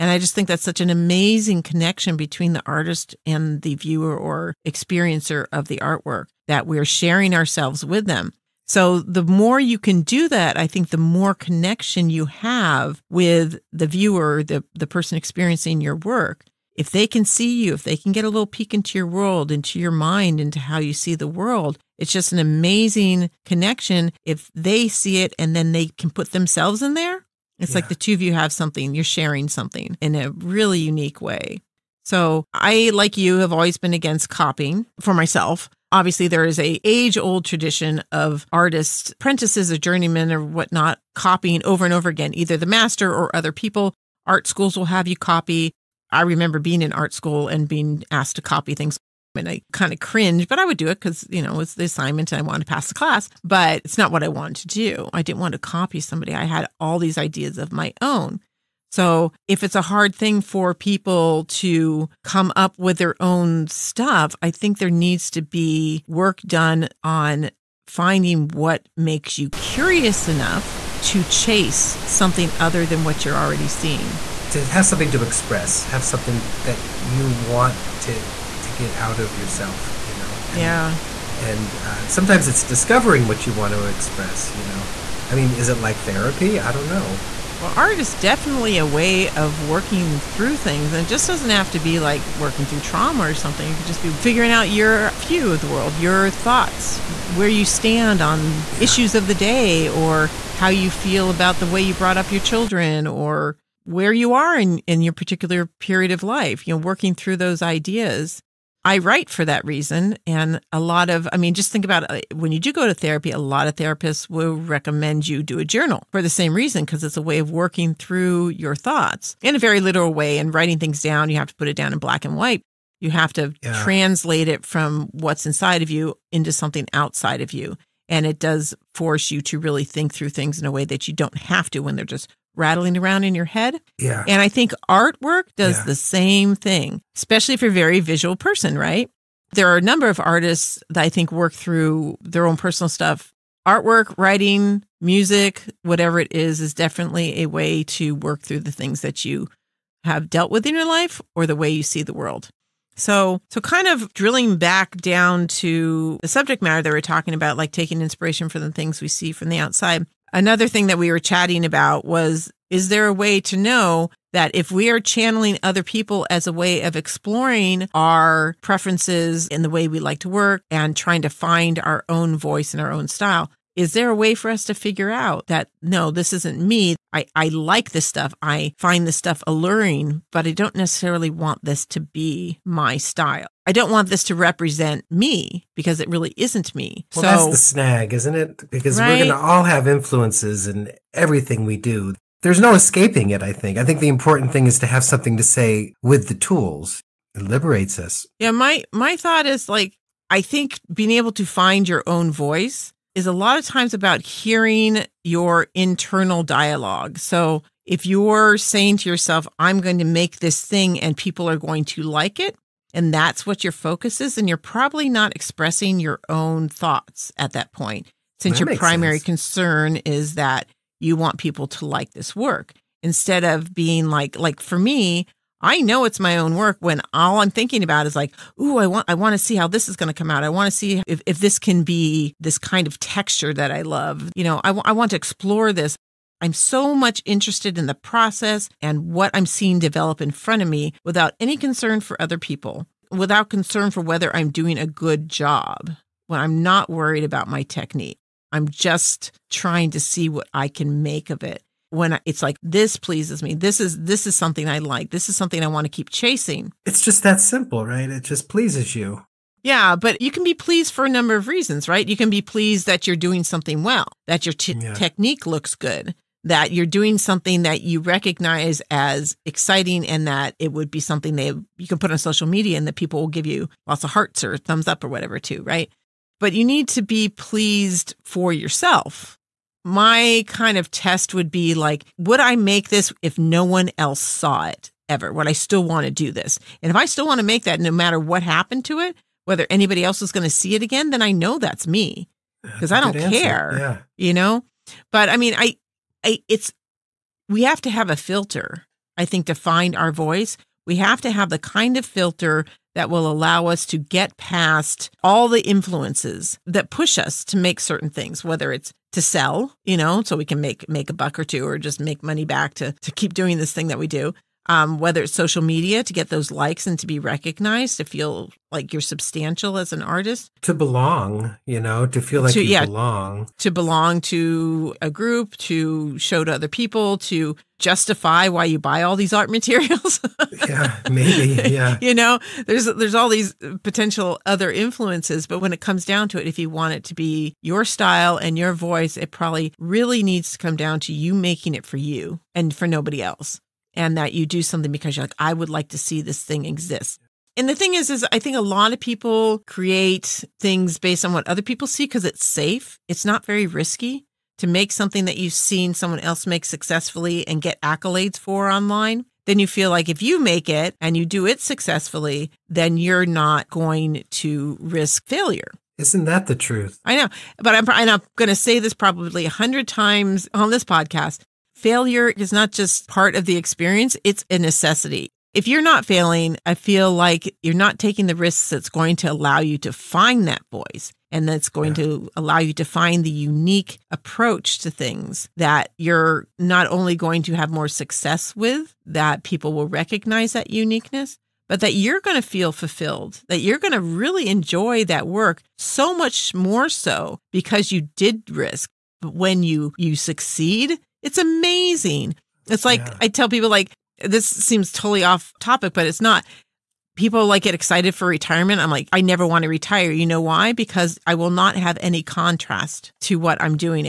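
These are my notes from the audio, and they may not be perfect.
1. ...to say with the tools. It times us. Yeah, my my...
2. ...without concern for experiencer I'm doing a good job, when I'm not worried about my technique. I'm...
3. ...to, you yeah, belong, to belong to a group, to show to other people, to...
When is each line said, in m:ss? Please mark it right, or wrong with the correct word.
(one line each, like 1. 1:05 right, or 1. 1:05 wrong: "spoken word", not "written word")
1. 3:15 wrong: "liberates", not "times"
2. 4:03 wrong: "whether", not "experiencer"
3. 5:22 right.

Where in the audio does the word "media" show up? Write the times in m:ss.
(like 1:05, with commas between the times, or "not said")
4:32, 5:15.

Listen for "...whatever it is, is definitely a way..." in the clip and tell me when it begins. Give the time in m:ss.
2:25.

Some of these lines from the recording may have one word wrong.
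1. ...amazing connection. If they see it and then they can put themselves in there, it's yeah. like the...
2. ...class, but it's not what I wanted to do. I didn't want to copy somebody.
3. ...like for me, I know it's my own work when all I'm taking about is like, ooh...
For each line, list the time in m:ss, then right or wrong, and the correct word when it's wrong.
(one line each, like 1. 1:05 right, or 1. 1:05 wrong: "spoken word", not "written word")
1. 0:22 right
2. 0:52 right
3. 3:44 wrong: "thinking", not "taking".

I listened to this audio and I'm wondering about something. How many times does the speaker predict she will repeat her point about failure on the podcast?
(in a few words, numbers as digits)
100.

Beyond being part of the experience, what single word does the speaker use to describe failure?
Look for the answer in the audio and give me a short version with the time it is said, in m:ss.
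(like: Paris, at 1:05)
A necessity, at 6:14.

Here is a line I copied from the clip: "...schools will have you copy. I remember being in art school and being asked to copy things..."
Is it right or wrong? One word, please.
right.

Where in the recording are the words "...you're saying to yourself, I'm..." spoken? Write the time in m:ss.
3:28.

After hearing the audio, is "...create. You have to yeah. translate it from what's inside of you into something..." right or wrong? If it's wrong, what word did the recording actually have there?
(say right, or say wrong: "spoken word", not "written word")
wrong: "white", not "create".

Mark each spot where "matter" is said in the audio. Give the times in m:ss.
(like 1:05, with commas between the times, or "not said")
2:36, 4:47.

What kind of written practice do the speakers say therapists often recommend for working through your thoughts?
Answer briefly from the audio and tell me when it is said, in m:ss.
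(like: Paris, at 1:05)
A journal, at 1:55.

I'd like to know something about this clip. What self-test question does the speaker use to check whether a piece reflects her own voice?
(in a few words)
Would I make this if no one else saw it ever.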